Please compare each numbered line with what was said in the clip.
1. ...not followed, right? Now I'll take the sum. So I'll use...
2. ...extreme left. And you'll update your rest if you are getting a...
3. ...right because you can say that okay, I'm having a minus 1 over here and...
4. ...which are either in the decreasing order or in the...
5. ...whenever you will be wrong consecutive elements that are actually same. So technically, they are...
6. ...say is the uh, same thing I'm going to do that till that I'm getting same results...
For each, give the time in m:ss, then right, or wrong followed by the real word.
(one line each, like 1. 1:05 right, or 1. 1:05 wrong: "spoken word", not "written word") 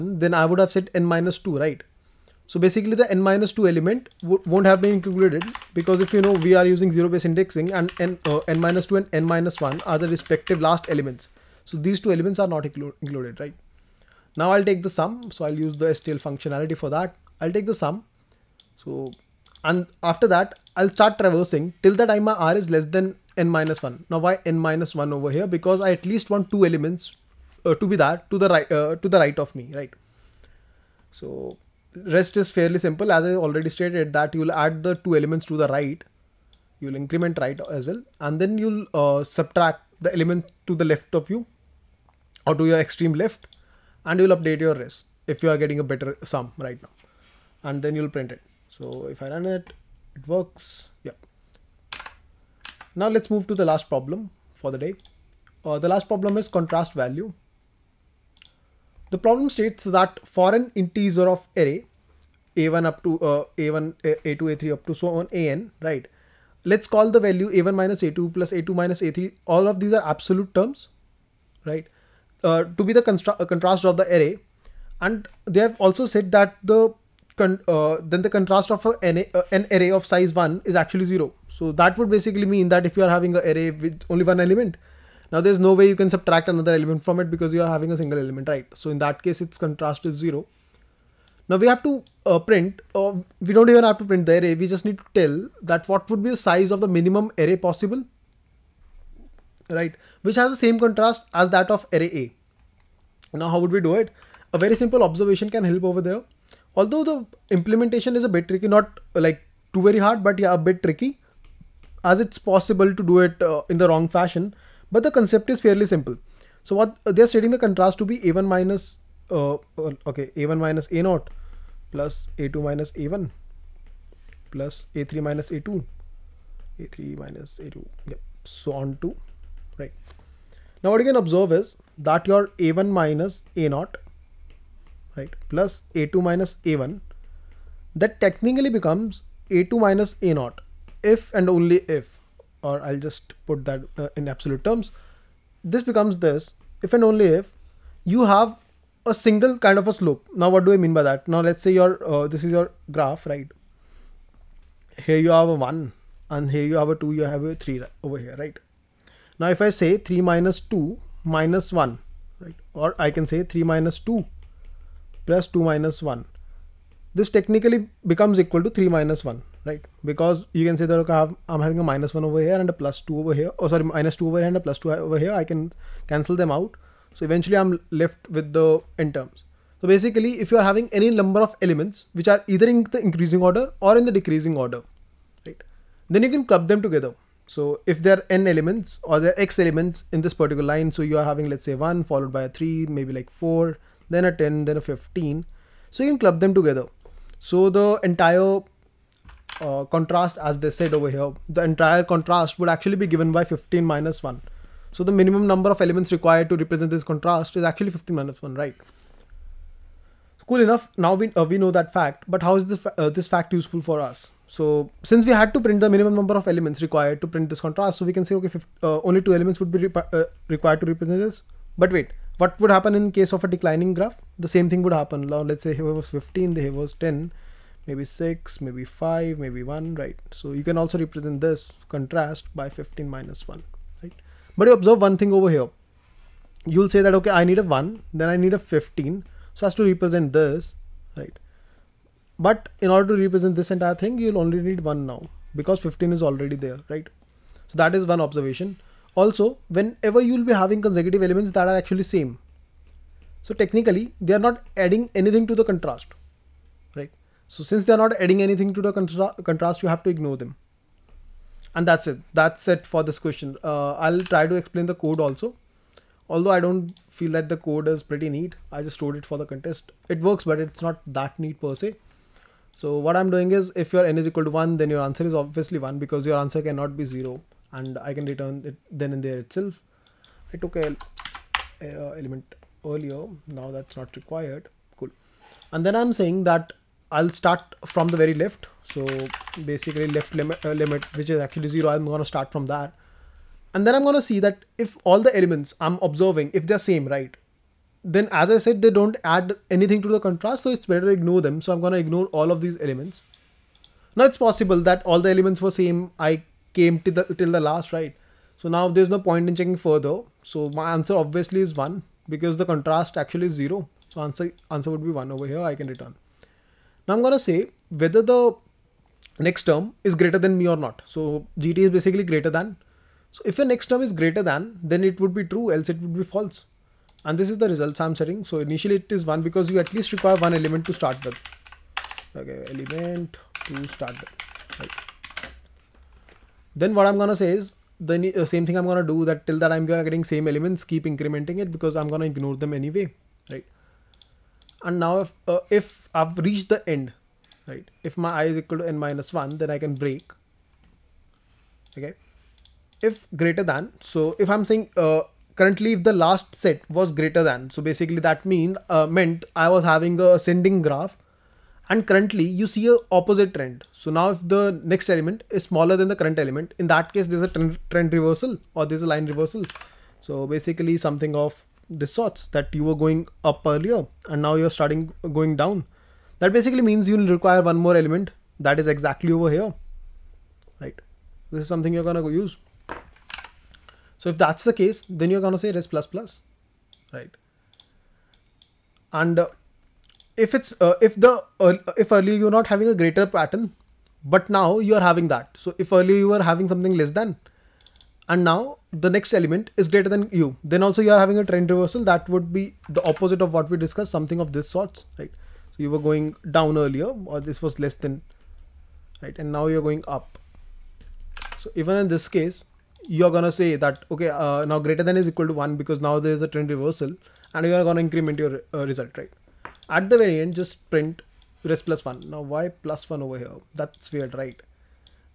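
1. 0:12 wrong: "included", not "followed"
2. 0:42 right
3. 2:49 right
4. 3:02 wrong: "increasing", not "decreasing"
5. 4:09 wrong: "having", not "wrong"
6. 5:37 wrong: "elements", not "results".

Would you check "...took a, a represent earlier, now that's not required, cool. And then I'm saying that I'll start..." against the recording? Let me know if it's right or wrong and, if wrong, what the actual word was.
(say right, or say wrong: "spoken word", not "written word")
wrong: "element", not "represent".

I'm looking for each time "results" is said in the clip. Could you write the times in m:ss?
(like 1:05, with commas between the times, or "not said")
5:27, 6:58.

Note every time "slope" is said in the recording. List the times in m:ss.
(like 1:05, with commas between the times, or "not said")
2:29.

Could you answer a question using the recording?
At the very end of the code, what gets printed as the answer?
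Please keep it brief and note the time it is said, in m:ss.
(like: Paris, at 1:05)
res + 1, at 7:01.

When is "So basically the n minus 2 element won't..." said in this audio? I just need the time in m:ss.
0:02.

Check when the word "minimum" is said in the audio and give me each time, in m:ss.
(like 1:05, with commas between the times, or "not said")
1:36, 3:25, 3:35.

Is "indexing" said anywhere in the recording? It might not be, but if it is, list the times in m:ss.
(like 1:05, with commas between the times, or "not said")
0:07.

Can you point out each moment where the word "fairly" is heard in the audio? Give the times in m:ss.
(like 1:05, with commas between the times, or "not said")
0:32, 1:55.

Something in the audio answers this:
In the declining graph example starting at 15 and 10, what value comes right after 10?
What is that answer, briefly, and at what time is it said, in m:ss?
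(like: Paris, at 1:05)
6, at 3:48.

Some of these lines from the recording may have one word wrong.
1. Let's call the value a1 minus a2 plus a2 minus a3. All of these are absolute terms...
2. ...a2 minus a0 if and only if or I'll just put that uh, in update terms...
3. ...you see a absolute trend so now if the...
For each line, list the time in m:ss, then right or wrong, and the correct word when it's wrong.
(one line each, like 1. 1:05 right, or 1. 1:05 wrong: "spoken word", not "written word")
1. 1:06 right
2. 2:19 wrong: "absolute", not "update"
3. 6:02 wrong: "opposite", not "absolute".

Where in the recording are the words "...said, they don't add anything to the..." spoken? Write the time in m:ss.
4:58.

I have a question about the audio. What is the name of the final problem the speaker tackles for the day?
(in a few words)
contrast value.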